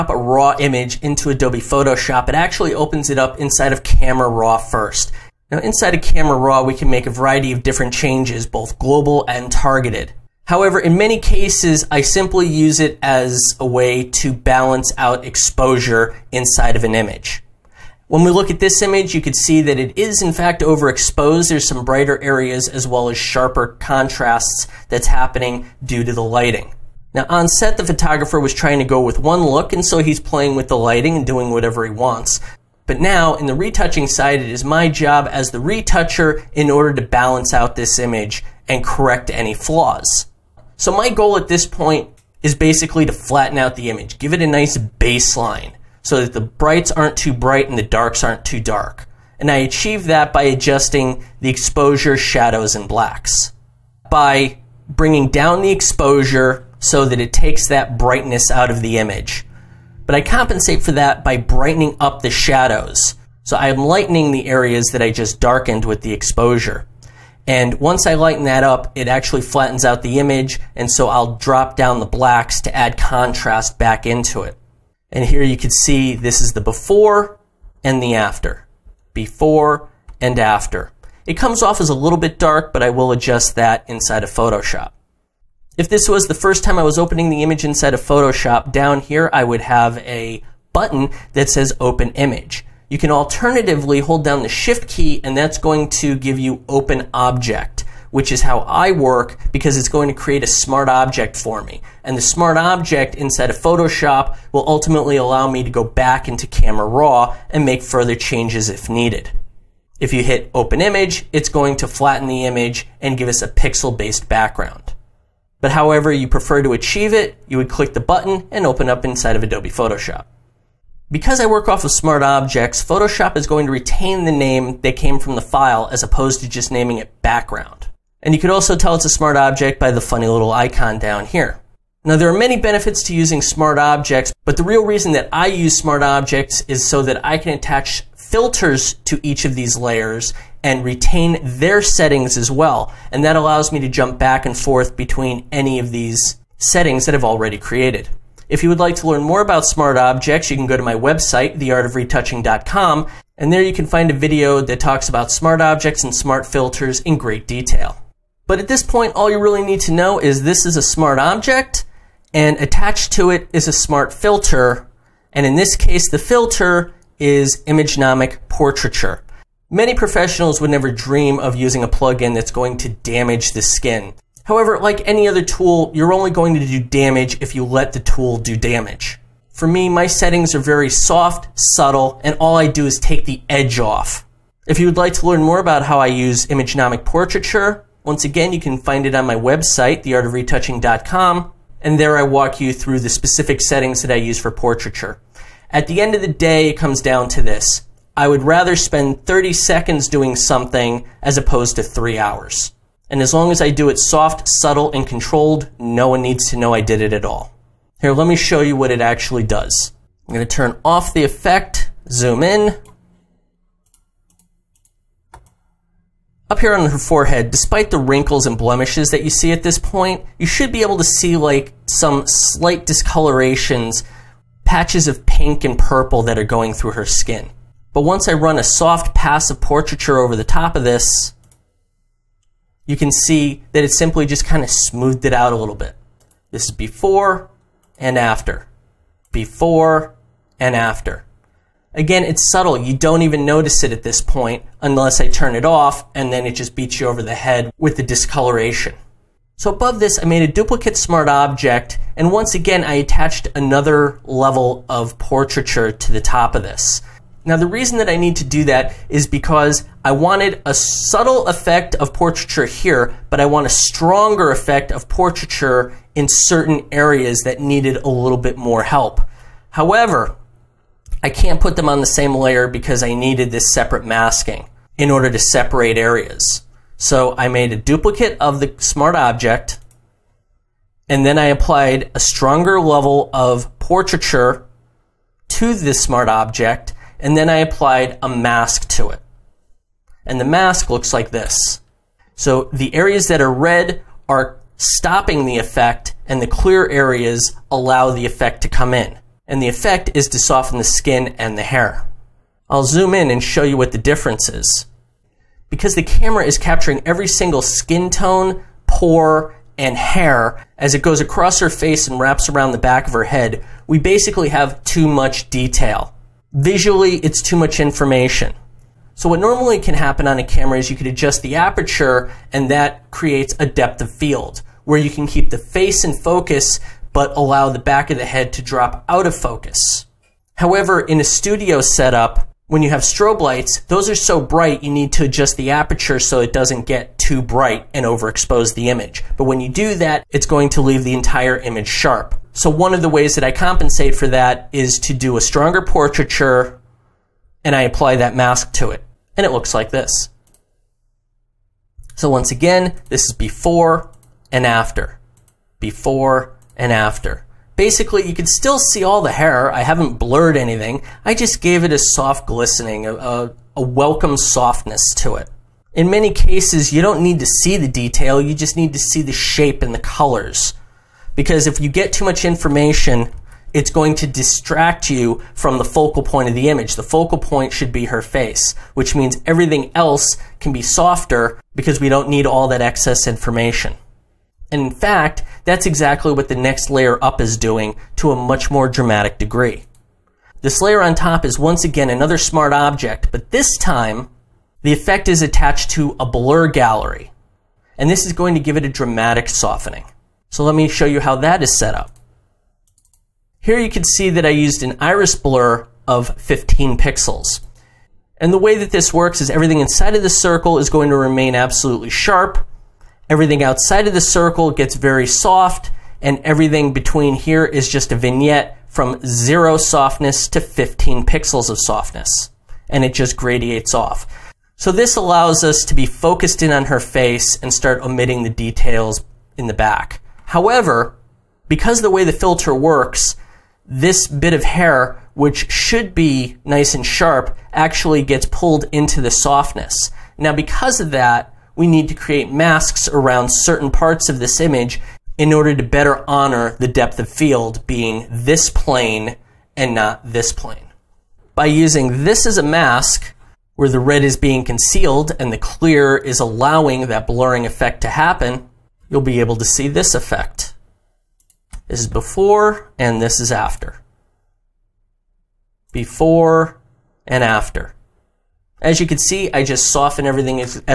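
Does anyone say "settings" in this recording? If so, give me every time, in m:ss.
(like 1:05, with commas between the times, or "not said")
2:21, 2:26, 3:00, 3:13.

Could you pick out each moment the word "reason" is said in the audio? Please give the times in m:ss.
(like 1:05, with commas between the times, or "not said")
2:14, 4:17.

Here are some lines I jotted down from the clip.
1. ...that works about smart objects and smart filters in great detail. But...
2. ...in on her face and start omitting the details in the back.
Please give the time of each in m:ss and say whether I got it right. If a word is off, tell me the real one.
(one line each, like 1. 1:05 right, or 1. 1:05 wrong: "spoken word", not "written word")
1. 2:34 wrong: "talks", not "works"
2. 7:06 right.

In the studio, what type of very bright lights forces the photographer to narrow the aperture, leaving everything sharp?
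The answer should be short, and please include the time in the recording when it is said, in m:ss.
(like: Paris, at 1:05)
Strobe lights, at 5:33.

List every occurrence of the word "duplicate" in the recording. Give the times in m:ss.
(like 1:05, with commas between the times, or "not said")
4:10, 4:37.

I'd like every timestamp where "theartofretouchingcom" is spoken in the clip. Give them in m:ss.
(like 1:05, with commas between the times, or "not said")
2:31, 3:10.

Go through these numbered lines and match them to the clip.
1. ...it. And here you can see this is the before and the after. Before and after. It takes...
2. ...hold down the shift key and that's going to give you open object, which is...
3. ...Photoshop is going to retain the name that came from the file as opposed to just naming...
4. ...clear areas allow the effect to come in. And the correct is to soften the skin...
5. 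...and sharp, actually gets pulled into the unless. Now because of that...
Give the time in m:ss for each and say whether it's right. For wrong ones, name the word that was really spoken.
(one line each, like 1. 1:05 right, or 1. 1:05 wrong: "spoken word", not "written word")
1. 1:14 wrong: "comes", not "takes"
2. 1:33 right
3. 2:02 right
4. 4:56 wrong: "effect", not "correct"
5. 7:16 wrong: "softness", not "unless".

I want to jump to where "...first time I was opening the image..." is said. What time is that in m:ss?
1:26.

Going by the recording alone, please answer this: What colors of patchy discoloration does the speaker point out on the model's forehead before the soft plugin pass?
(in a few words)
Pink and purple.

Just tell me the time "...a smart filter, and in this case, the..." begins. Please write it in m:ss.
2:43.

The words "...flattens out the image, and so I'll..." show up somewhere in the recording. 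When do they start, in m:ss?
1:09.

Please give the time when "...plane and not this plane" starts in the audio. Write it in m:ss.
7:28.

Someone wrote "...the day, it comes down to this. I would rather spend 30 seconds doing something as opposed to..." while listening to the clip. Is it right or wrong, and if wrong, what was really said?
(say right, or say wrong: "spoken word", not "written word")
right.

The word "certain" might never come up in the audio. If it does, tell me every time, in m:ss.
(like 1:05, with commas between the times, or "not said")
4:26, 7:23.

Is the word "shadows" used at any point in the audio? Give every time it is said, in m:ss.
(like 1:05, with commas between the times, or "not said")
0:52, 1:02.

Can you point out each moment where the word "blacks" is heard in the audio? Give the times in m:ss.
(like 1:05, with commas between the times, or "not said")
0:52, 1:12.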